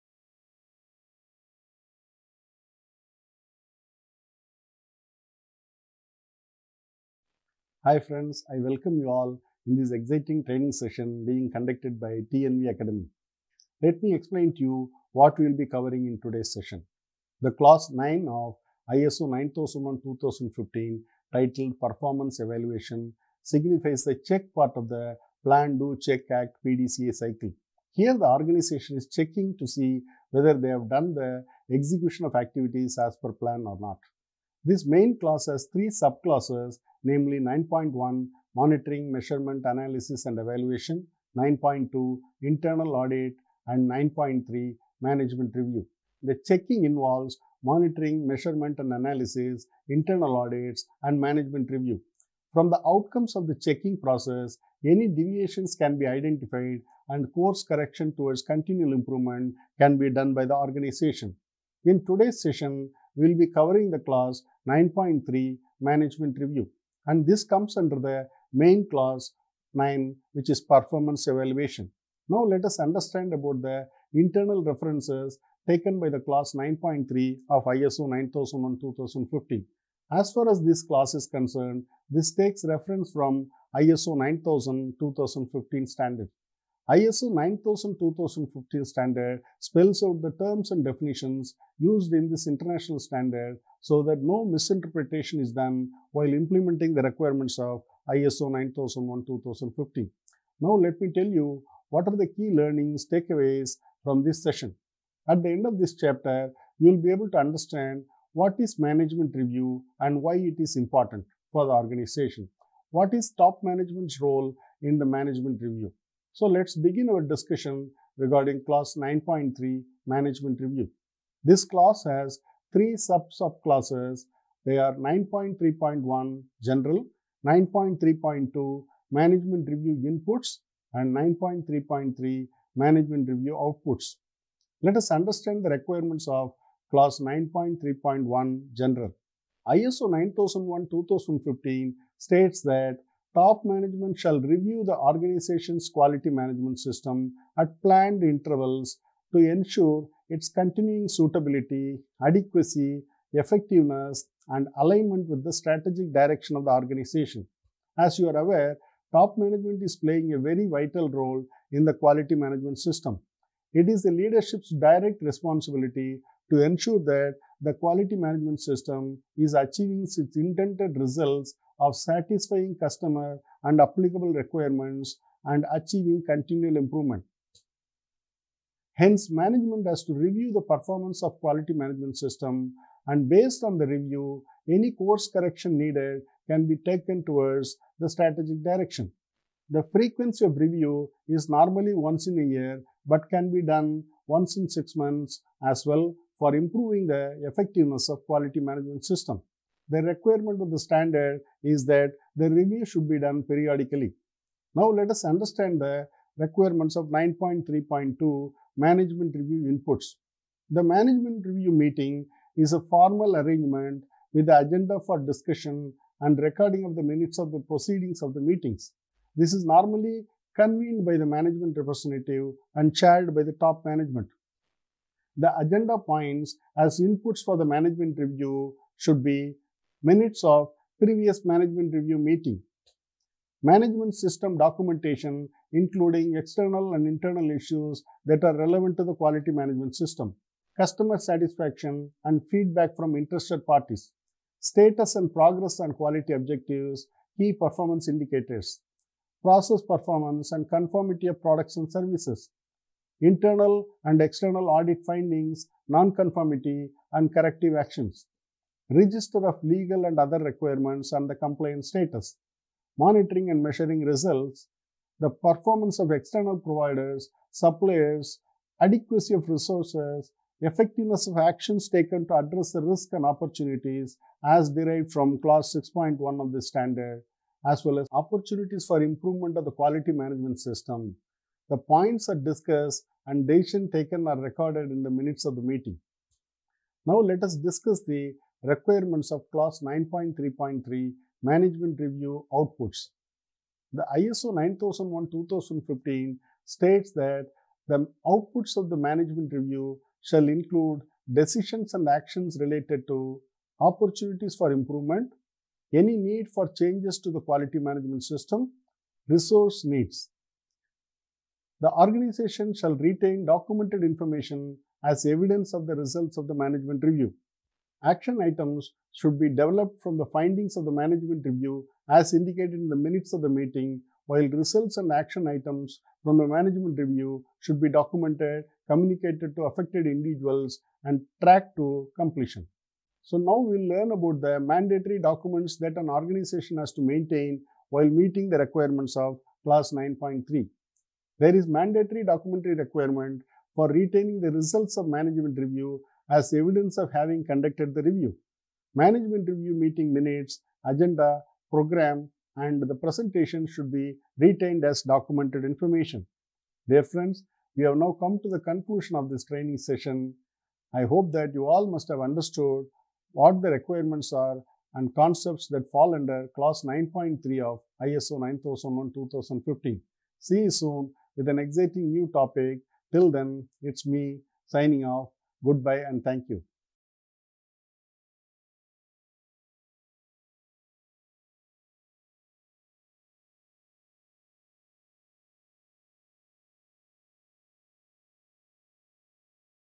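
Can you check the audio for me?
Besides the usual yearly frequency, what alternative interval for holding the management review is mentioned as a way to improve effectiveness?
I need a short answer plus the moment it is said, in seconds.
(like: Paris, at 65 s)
Once in six months, at 194 s.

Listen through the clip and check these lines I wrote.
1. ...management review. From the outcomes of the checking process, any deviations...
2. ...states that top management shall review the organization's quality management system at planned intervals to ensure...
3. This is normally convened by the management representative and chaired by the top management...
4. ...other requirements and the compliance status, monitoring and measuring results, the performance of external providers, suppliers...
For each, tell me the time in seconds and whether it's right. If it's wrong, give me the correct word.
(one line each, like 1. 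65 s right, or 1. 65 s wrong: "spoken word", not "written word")
1. 51 s right
2. 142 s right
3. 219 s right
4. 260 s right.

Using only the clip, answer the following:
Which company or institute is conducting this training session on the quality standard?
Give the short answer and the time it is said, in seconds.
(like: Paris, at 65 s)
TNV Akademi, at 12 s.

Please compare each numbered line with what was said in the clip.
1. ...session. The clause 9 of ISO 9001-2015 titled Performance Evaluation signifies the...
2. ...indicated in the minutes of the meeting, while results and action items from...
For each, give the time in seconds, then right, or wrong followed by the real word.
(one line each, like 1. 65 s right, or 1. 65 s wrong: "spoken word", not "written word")
1. 16 s right
2. 322 s right.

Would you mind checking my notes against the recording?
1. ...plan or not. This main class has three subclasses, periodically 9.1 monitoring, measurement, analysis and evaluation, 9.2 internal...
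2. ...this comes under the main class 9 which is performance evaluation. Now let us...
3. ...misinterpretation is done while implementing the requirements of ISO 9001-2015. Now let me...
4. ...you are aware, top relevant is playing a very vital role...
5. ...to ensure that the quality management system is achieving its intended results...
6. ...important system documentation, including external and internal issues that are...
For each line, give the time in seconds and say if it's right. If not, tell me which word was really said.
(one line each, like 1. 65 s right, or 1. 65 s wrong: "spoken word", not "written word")
1. 33 s wrong: "namely", not "periodically"
2. 67 s right
3. 94 s right
4. 158 s wrong: "management", not "relevant"
5. 166 s right
6. 233 s wrong: "management", not "important".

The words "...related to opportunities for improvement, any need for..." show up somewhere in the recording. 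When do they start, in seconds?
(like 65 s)
302 s.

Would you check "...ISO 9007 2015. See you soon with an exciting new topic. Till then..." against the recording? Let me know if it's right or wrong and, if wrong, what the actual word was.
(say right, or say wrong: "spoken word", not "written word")
wrong: "9001", not "9007".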